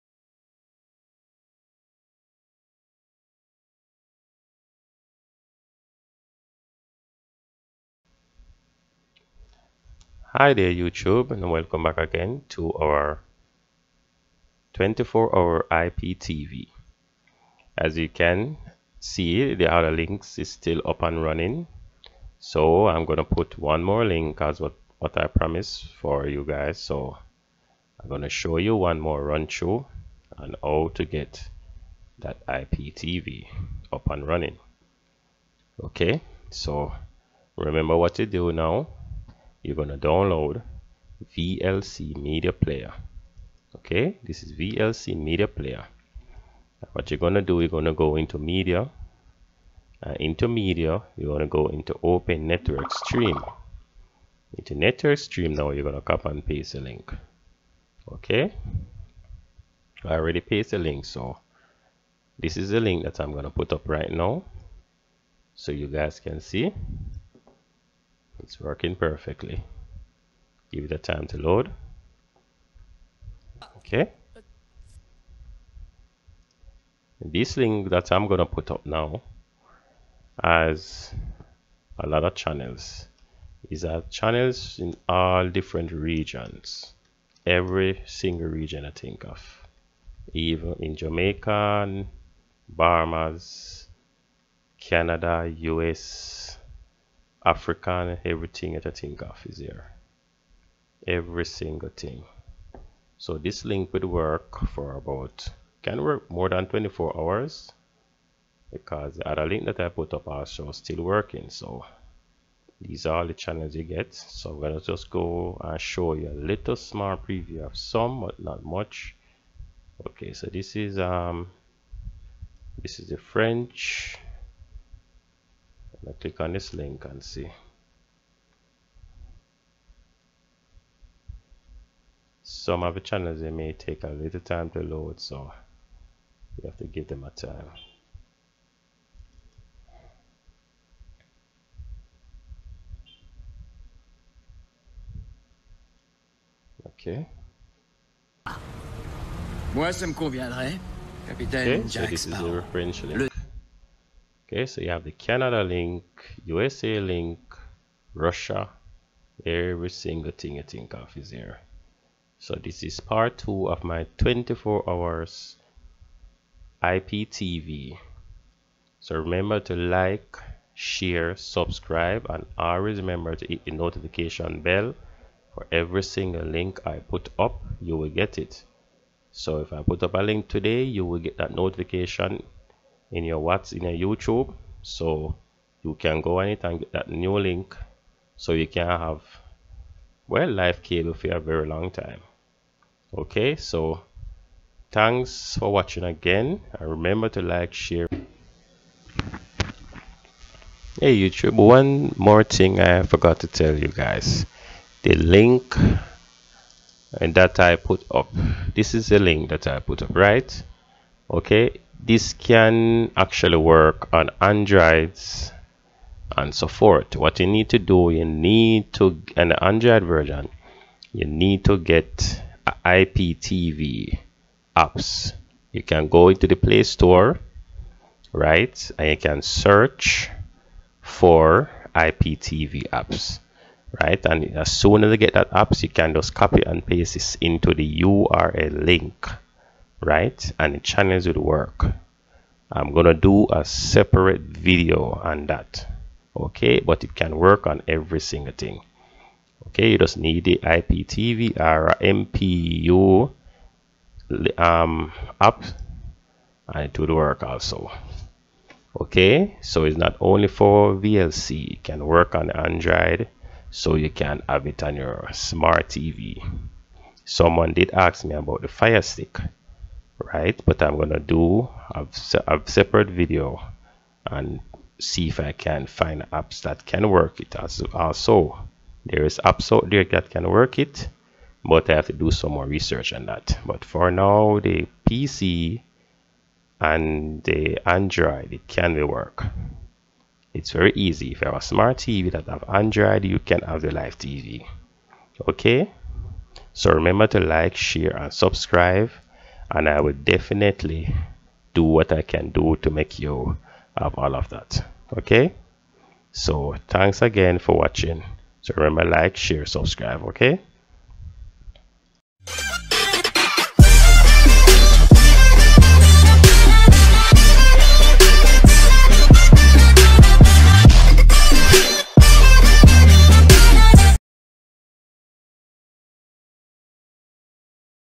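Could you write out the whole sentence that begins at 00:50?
Uh, into Media, you're going to go into Open Network Stream.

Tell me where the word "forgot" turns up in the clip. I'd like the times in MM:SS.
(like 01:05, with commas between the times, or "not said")
03:23.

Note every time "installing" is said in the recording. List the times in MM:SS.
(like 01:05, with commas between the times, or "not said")
not said.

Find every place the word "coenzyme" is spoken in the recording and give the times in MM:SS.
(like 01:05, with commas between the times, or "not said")
not said.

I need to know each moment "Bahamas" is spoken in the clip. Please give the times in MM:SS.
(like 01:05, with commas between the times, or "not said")
01:32.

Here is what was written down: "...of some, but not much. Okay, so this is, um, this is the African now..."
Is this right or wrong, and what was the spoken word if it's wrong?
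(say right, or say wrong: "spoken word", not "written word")
wrong: "French", not "African".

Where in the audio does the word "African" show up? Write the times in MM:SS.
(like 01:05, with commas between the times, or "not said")
01:37.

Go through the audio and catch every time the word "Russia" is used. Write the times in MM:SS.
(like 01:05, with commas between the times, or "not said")
02:38.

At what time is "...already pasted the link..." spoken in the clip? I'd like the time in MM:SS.
01:00.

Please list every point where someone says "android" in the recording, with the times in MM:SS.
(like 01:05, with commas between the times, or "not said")
03:34, 03:39, 04:22, 04:47, 04:52.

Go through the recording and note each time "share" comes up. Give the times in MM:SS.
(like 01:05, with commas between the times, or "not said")
02:50, 03:17, 04:57, 05:09.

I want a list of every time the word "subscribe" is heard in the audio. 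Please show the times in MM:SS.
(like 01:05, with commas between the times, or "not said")
02:51, 04:58, 05:09.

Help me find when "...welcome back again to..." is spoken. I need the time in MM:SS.
00:11.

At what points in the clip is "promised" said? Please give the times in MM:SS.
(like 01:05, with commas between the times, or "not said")
00:25.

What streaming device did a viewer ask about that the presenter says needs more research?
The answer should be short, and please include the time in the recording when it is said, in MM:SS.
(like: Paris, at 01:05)
Fire Stick, at 04:28.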